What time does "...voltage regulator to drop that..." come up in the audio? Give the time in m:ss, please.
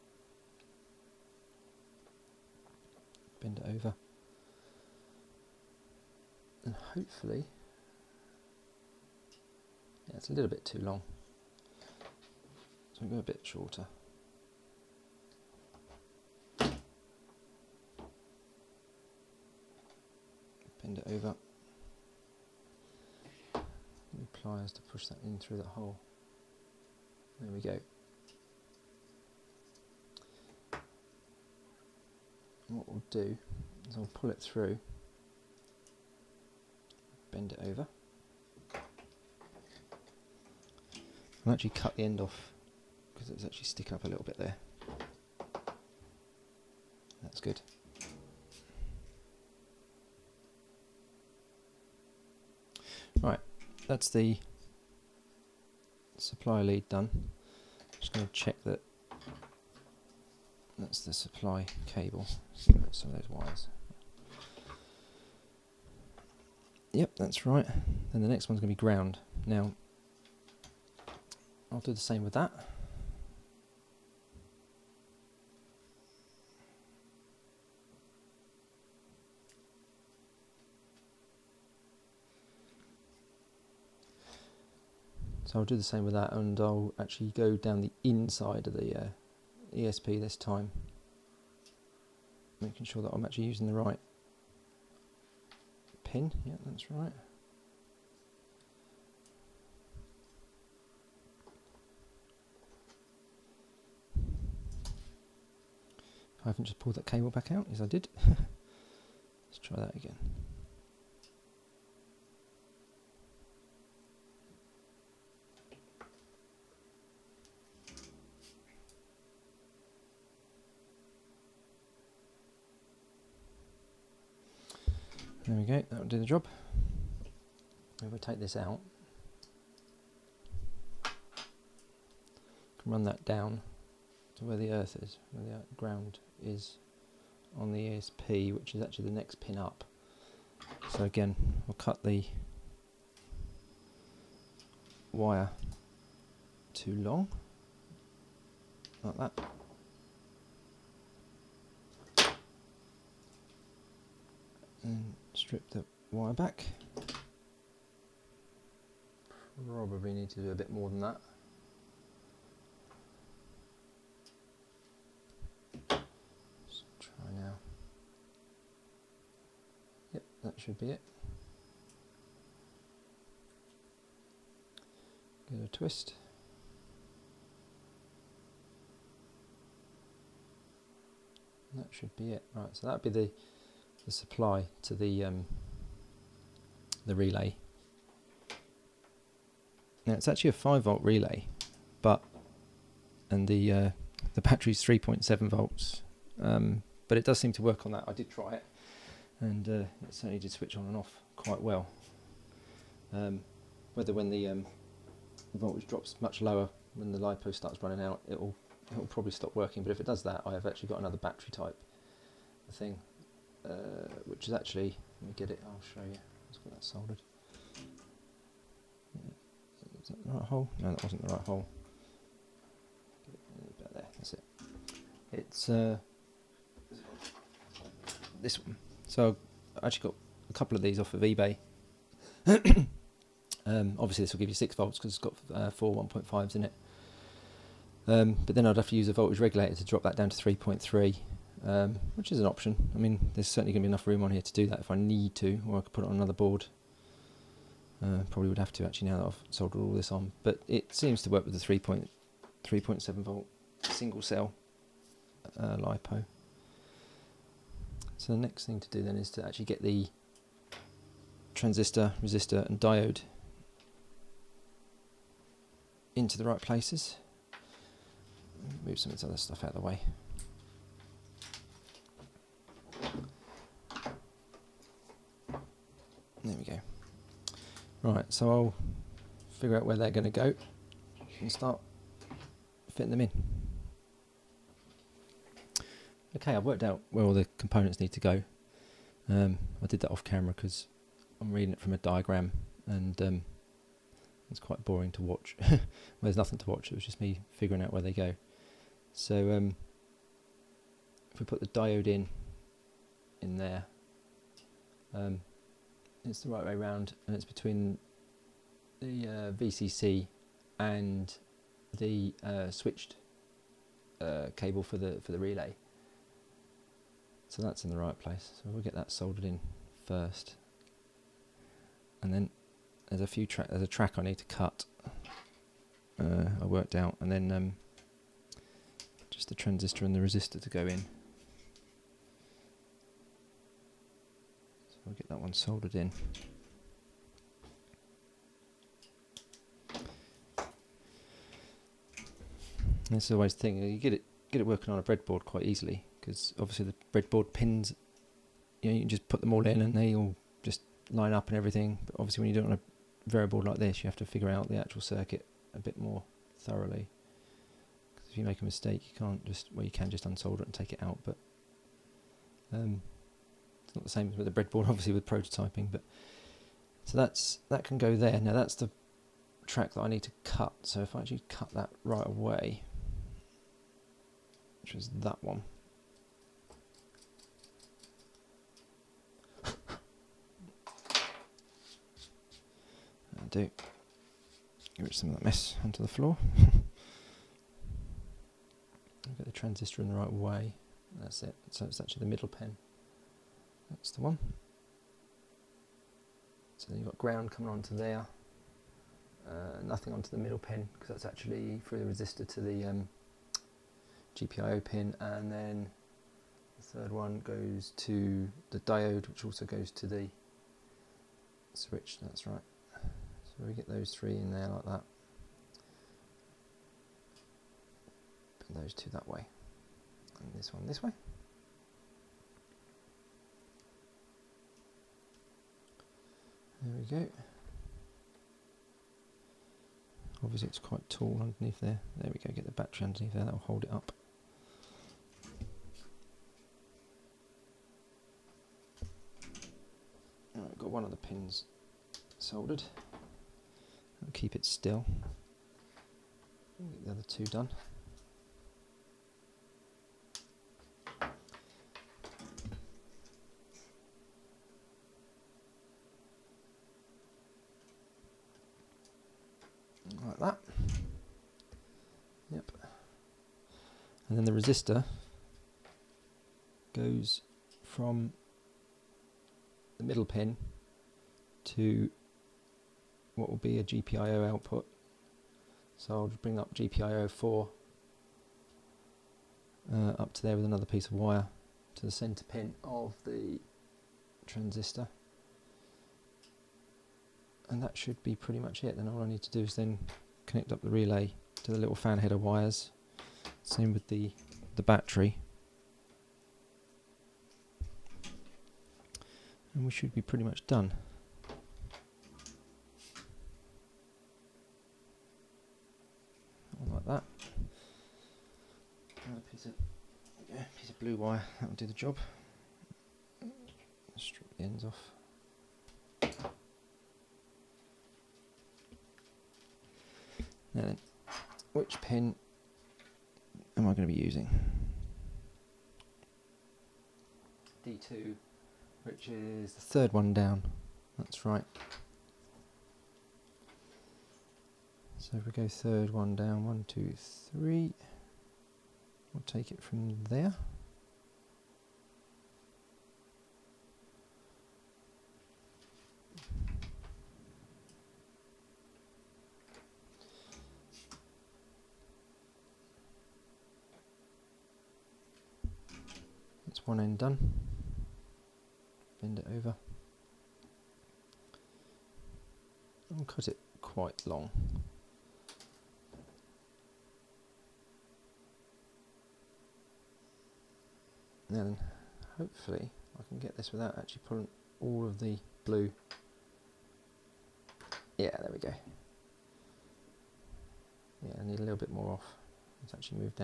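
3:59.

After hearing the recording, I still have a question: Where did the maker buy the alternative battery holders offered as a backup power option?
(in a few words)
eBay.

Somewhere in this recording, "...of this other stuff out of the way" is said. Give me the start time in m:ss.
4:29.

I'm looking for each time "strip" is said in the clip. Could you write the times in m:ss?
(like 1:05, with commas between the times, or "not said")
2:35, 8:34.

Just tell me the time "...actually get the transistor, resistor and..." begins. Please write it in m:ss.
4:19.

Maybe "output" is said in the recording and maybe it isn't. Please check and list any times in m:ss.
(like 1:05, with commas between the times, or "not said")
7:54.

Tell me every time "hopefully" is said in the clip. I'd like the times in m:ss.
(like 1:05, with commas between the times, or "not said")
0:06, 9:32.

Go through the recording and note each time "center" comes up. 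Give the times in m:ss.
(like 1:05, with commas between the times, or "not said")
8:02.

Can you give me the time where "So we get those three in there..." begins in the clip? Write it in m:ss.
6:52.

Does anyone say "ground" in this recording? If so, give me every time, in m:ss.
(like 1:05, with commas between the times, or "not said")
1:08, 2:15, 6:37.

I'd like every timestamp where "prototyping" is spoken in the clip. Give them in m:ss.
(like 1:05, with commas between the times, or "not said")
6:05.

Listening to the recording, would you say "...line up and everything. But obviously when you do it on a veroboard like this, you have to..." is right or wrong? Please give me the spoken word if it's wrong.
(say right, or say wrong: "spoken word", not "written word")
right.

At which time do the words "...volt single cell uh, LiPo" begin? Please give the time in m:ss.
4:13.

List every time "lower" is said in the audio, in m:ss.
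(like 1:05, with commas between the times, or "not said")
3:26.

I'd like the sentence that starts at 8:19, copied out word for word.
And we should be pretty much done.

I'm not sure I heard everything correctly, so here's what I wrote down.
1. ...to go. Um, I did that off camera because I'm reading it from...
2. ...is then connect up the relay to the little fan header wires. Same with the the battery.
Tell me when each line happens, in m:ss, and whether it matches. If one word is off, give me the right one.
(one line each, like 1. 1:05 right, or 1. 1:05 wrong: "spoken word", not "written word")
1. 4:48 right
2. 8:09 right.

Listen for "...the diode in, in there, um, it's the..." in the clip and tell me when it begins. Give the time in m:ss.
5:01.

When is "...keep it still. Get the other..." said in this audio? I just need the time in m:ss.
7:24.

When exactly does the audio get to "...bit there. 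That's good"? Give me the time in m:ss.
0:44.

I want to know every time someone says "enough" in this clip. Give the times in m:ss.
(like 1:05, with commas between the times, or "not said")
4:03.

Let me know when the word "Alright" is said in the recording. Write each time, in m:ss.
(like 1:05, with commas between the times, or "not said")
7:20.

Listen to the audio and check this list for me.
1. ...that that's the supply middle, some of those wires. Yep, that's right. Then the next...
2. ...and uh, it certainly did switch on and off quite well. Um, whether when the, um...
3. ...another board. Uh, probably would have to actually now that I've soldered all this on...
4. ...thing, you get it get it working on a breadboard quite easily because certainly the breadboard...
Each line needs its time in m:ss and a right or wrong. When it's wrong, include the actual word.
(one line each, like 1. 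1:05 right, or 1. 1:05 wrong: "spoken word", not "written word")
1. 0:58 wrong: "cable", not "middle"
2. 3:19 right
3. 4:06 right
4. 5:43 wrong: "obviously", not "certainly".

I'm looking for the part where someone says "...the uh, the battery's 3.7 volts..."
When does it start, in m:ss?
3:13.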